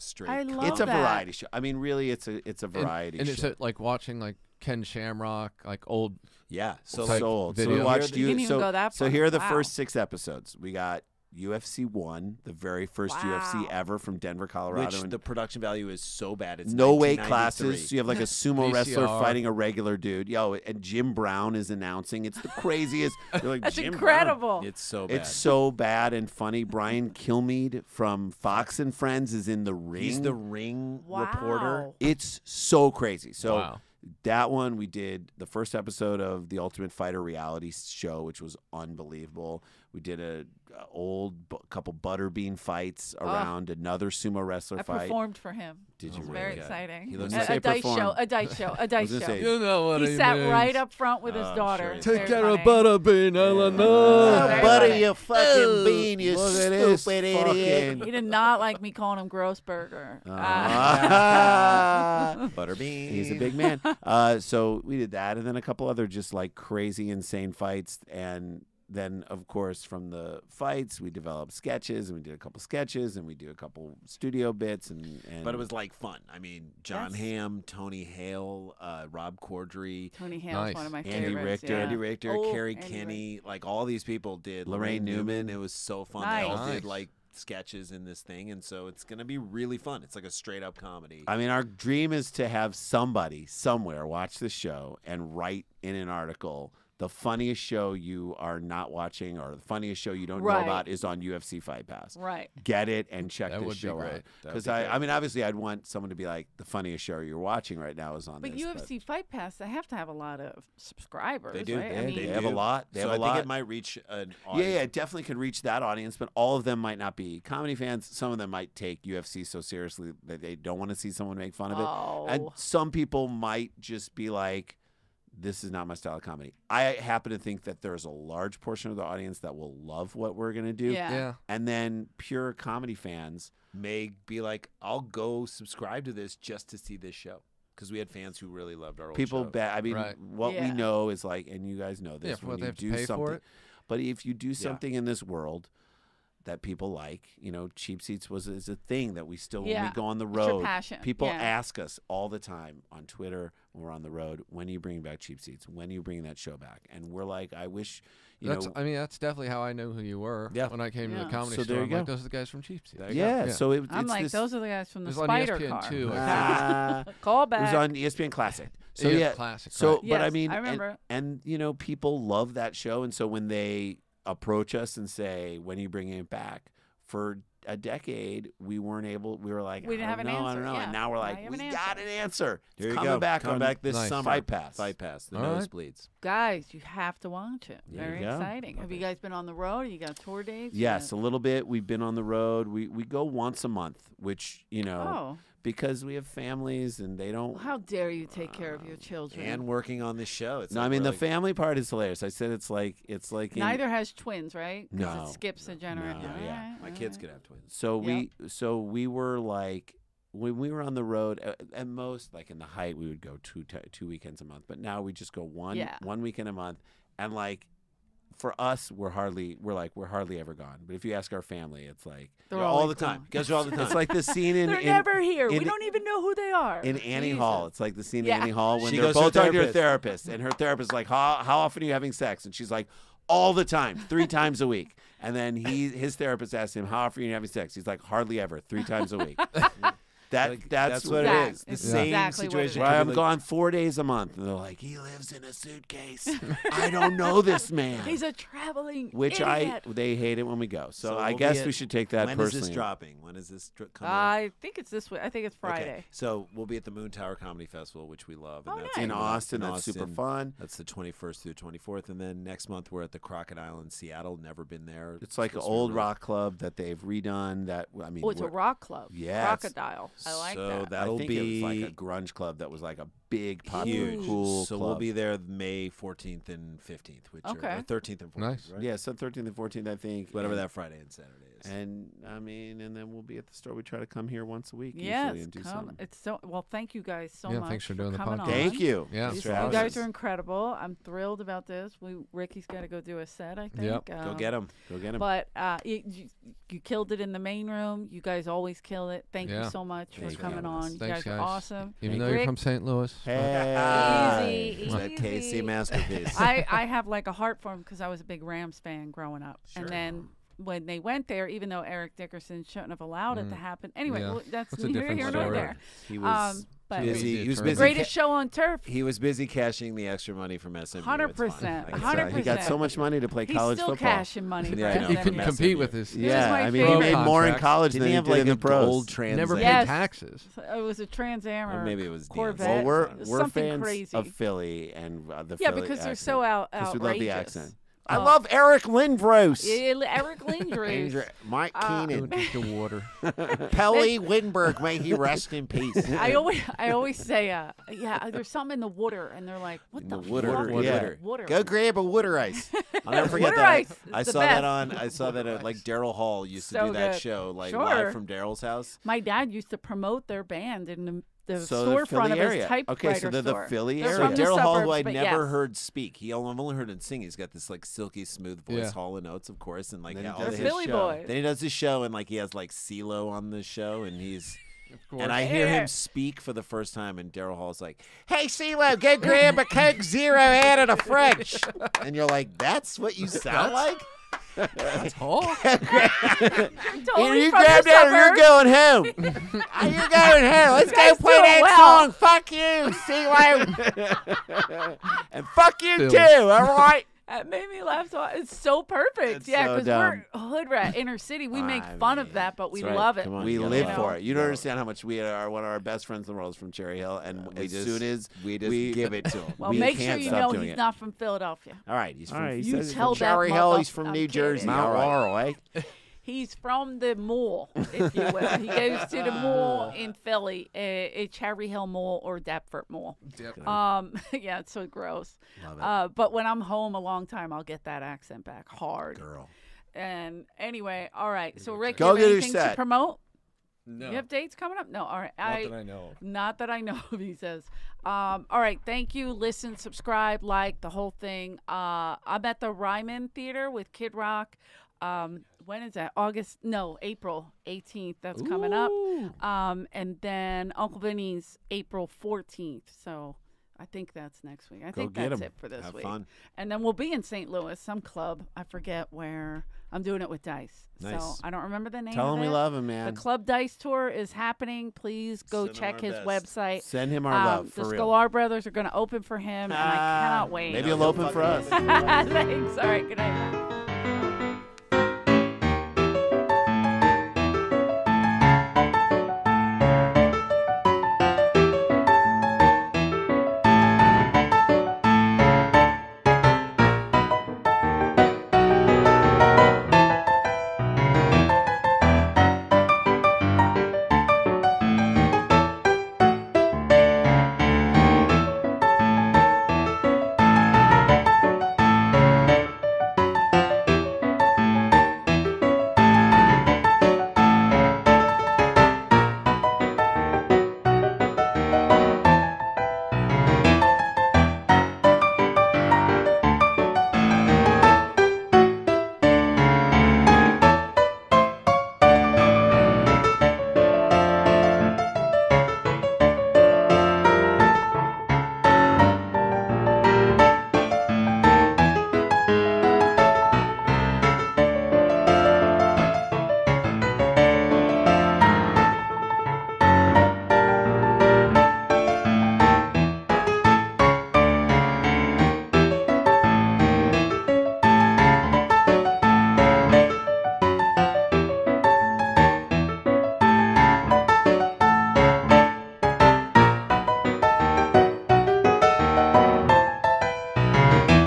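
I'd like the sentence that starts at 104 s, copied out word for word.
I mean, obviously, I'd want someone to be like, the funniest show you're watching right now is on.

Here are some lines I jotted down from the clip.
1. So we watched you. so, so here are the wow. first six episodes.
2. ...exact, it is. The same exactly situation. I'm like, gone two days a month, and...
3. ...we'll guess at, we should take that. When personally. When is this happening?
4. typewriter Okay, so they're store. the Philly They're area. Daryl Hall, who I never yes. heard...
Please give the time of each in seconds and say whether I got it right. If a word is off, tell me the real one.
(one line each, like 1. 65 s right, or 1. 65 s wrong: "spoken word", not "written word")
1. 7 s right
2. 241 s wrong: "four", not "two"
3. 251 s wrong: "dropping", not "happening"
4. 362 s right.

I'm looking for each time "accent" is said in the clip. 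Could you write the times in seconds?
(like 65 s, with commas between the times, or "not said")
337 s, 428 s.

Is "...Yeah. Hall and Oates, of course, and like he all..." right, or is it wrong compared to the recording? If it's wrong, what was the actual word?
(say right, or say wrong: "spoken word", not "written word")
right.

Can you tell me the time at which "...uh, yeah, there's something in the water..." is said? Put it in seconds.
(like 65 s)
347 s.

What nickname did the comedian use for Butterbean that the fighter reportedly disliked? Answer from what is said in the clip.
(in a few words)
Grossberger.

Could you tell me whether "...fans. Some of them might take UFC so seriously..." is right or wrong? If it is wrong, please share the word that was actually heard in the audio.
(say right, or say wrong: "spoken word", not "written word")
right.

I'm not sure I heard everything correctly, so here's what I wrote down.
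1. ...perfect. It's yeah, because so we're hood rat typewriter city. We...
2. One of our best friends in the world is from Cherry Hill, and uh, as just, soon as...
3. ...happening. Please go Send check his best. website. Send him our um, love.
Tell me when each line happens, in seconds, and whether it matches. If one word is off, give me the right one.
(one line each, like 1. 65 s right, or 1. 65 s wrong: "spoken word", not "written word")
1. 398 s wrong: "inner", not "typewriter"
2. 405 s right
3. 464 s right.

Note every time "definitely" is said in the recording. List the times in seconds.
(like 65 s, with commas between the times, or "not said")
114 s, 159 s.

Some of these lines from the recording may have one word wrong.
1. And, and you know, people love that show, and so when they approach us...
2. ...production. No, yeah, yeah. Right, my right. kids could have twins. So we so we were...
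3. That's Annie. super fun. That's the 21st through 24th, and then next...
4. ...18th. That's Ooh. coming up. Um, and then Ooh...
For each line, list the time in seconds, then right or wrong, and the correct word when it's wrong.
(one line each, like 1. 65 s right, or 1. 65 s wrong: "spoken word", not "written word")
1. 171 s right
2. 205 s wrong: "generation", not "production"
3. 259 s wrong: "Austin", not "Annie"
4. 447 s wrong: "Uncle", not "Ooh".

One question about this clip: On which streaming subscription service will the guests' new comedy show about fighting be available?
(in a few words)
UFC Fight Pass.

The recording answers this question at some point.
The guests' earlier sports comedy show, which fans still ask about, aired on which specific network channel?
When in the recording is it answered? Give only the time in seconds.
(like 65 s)
167 s.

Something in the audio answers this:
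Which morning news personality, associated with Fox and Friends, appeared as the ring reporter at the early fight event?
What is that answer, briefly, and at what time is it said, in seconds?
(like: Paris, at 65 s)
Brian Kilmeade, at 26 s.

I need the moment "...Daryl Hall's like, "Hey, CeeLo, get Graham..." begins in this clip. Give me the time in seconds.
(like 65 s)
377 s.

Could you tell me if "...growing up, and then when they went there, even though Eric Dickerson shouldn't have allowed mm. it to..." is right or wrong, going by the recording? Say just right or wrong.
right.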